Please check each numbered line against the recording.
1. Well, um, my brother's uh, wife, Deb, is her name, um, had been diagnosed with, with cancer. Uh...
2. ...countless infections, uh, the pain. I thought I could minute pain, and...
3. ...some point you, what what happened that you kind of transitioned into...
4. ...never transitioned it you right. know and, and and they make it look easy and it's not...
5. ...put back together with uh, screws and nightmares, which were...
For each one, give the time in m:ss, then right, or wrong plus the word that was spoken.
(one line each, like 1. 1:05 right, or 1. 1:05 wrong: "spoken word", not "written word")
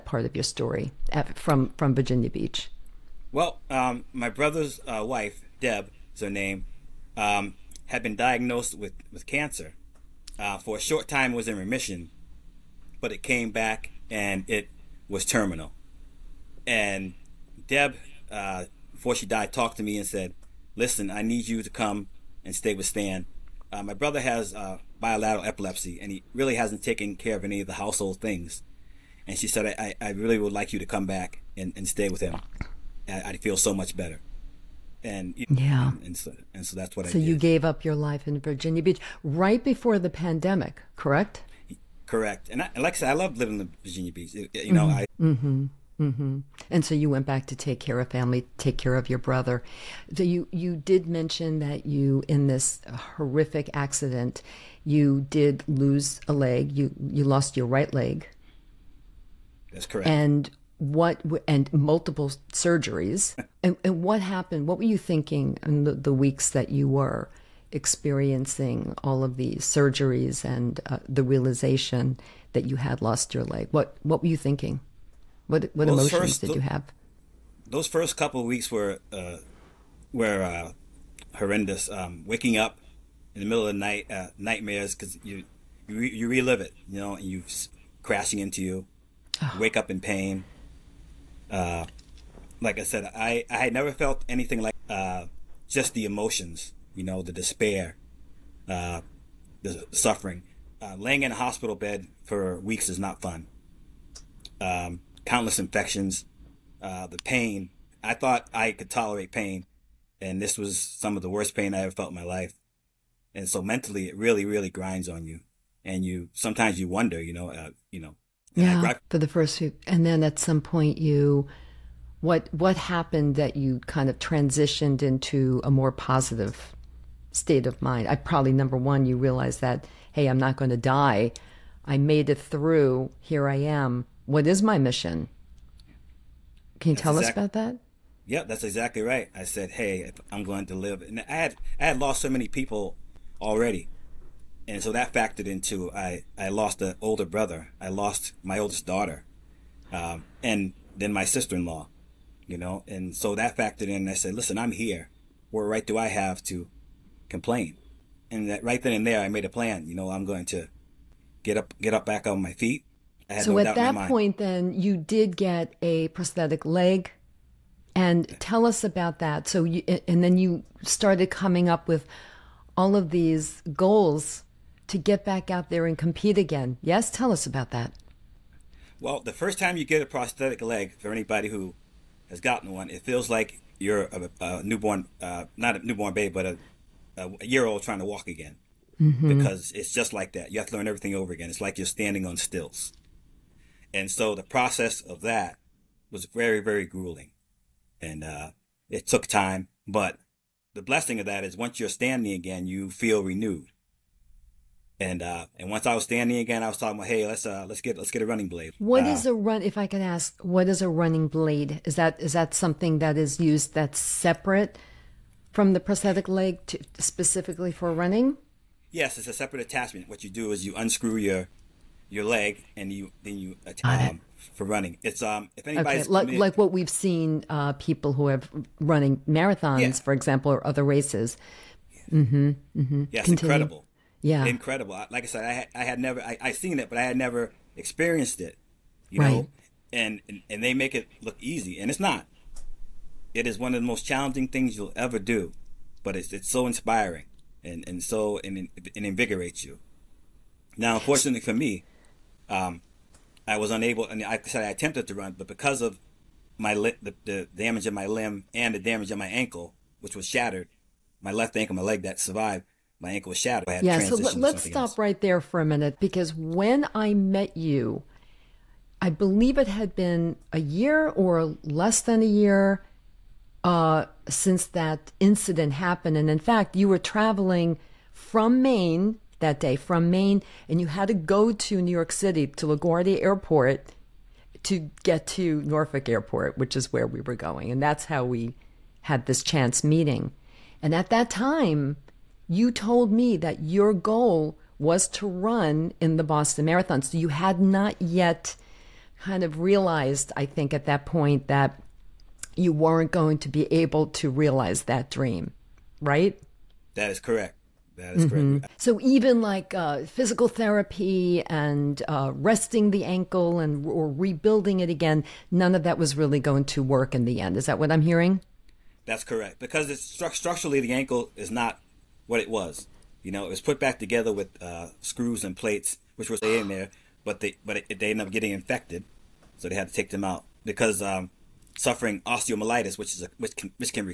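1. 0:03 right
2. 1:45 wrong: "tolerate", not "minute"
3. 2:00 right
4. 3:57 wrong: "experienced", not "transitioned"
5. 5:23 wrong: "plates", not "nightmares".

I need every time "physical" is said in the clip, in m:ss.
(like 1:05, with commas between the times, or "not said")
5:10.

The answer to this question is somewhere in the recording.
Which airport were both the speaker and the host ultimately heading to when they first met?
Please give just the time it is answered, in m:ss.
4:45.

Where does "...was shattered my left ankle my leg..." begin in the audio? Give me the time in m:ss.
4:20.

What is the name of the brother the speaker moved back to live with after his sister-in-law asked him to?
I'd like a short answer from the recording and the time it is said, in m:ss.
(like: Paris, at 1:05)
Stan, at 0:22.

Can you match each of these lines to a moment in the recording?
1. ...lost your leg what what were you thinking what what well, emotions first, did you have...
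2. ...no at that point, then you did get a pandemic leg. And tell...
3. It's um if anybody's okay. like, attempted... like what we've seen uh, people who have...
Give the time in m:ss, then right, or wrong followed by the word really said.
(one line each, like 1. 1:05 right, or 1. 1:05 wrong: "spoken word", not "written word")
1. 1:13 right
2. 2:43 wrong: "prosthetic", not "pandemic"
3. 3:45 wrong: "committed", not "attempted".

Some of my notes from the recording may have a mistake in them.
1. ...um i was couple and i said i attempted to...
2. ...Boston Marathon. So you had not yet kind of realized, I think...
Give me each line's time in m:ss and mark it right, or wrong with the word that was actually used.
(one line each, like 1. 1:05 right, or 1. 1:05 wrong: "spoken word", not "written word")
1. 4:12 wrong: "unable", not "couple"
2. 4:56 right.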